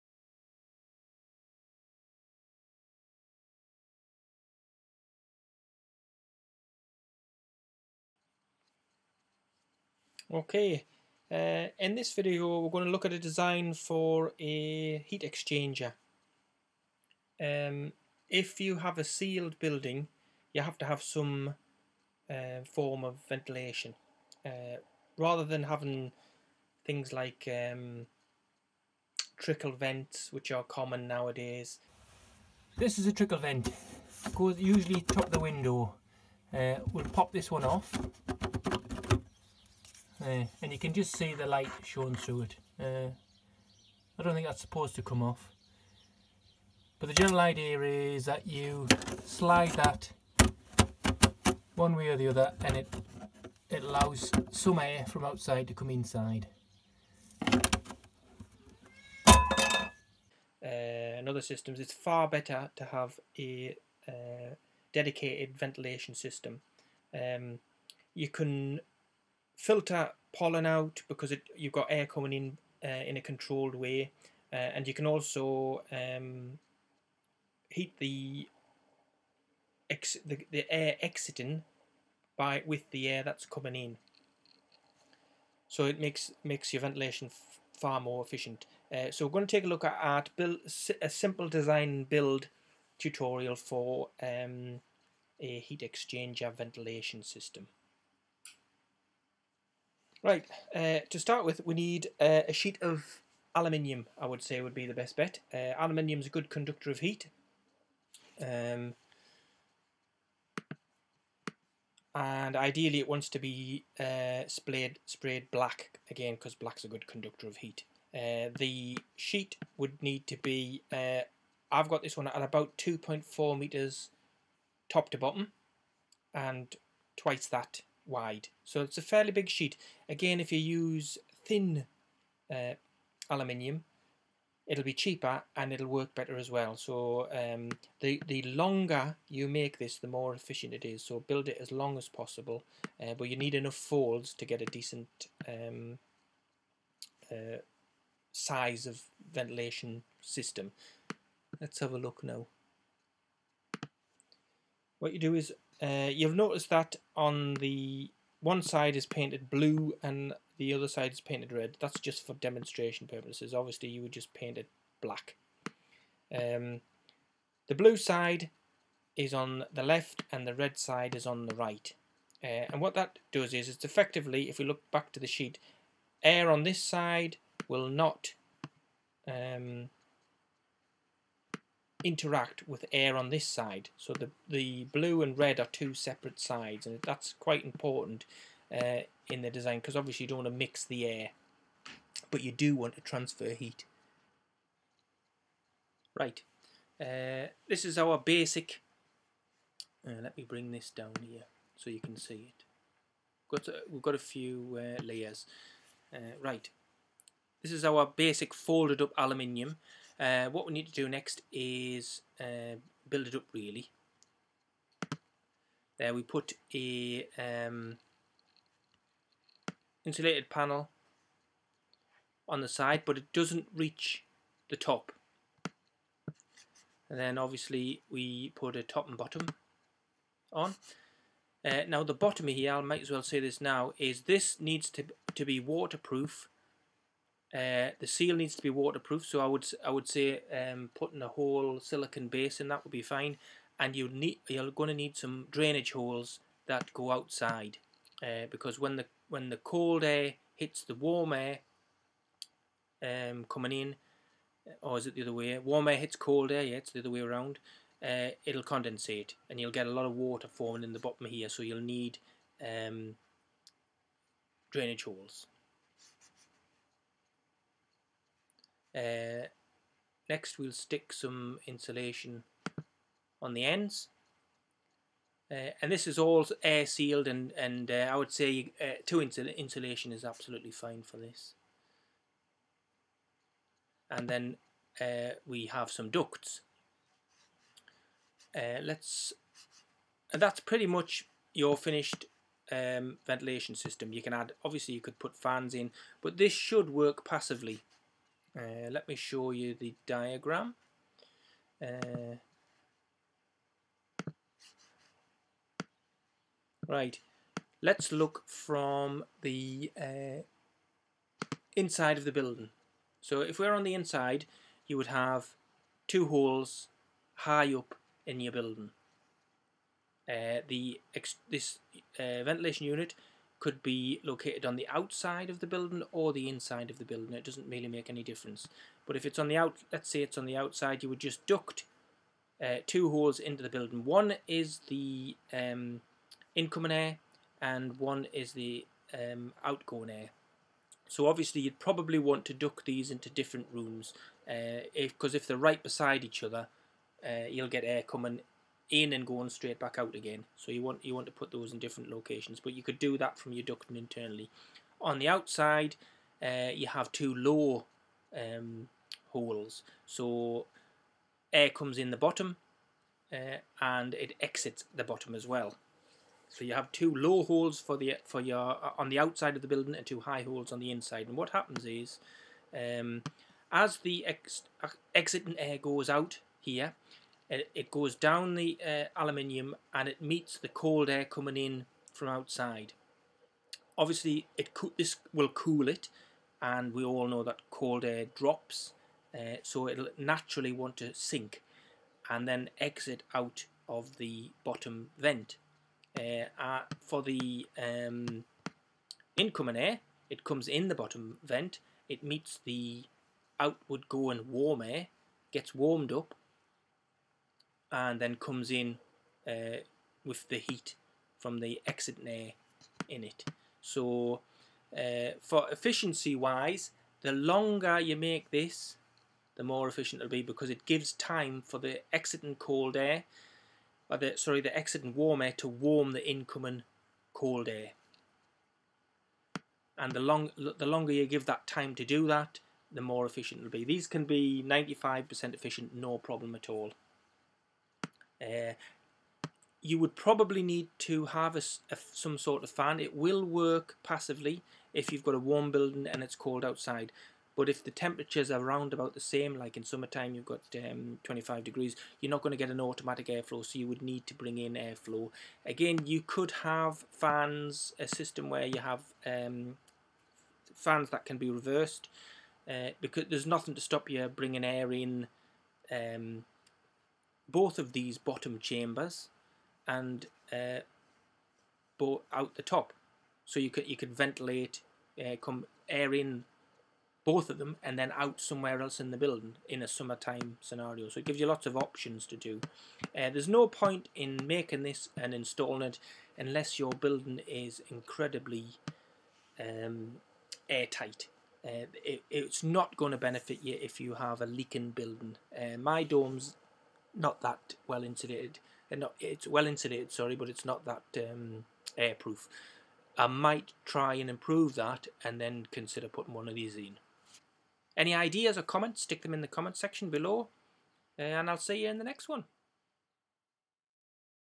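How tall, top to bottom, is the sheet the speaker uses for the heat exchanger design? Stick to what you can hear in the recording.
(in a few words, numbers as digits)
2.4 metres.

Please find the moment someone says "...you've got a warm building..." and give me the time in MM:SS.
07:25.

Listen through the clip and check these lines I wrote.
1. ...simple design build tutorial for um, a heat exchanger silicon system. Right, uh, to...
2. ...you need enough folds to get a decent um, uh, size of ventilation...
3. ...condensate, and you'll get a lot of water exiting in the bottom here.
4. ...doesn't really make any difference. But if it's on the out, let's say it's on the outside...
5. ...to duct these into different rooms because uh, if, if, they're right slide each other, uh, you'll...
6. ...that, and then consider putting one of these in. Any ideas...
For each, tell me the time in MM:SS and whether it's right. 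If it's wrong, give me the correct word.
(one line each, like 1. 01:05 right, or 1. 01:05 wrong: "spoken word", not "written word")
1. 01:31 wrong: "ventilation", not "silicon"
2. 02:23 right
3. 04:18 wrong: "forming", not "exiting"
4. 05:27 right
5. 05:42 wrong: "beside", not "slide"
6. 08:24 right.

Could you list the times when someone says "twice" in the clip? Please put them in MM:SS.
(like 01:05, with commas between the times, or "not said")
02:07.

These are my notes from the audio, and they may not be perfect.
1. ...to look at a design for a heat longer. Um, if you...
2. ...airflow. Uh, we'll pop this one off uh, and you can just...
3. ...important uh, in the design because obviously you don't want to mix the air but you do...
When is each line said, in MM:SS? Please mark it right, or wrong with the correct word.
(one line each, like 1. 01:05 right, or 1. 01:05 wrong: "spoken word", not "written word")
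1. 00:12 wrong: "exchanger", not "longer"
2. 00:35 wrong: "window", not "airflow"
3. 03:07 right.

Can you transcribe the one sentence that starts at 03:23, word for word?
Got we've got a few uh, layers.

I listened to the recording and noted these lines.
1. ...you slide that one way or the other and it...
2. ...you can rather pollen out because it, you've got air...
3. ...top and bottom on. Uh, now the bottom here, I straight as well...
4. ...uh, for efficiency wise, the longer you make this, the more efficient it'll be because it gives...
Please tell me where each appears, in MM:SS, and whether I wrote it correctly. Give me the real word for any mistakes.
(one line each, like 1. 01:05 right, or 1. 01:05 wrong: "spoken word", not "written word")
1. 00:48 right
2. 01:08 wrong: "filter", not "rather"
3. 03:48 wrong: "might", not "straight"
4. 06:54 right.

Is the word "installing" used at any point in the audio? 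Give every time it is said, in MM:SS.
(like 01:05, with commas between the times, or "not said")
08:05.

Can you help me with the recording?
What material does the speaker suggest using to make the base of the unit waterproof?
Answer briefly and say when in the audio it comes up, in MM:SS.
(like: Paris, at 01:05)
Silicon, at 04:01.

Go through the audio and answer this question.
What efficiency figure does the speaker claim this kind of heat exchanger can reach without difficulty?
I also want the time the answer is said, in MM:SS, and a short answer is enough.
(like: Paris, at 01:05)
95%, at 07:14.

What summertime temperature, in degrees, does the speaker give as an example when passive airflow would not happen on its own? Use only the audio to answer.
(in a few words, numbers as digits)
25 degrees.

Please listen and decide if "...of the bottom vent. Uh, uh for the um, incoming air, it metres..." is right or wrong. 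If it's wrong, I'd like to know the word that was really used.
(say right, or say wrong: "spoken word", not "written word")
wrong: "comes", not "metres".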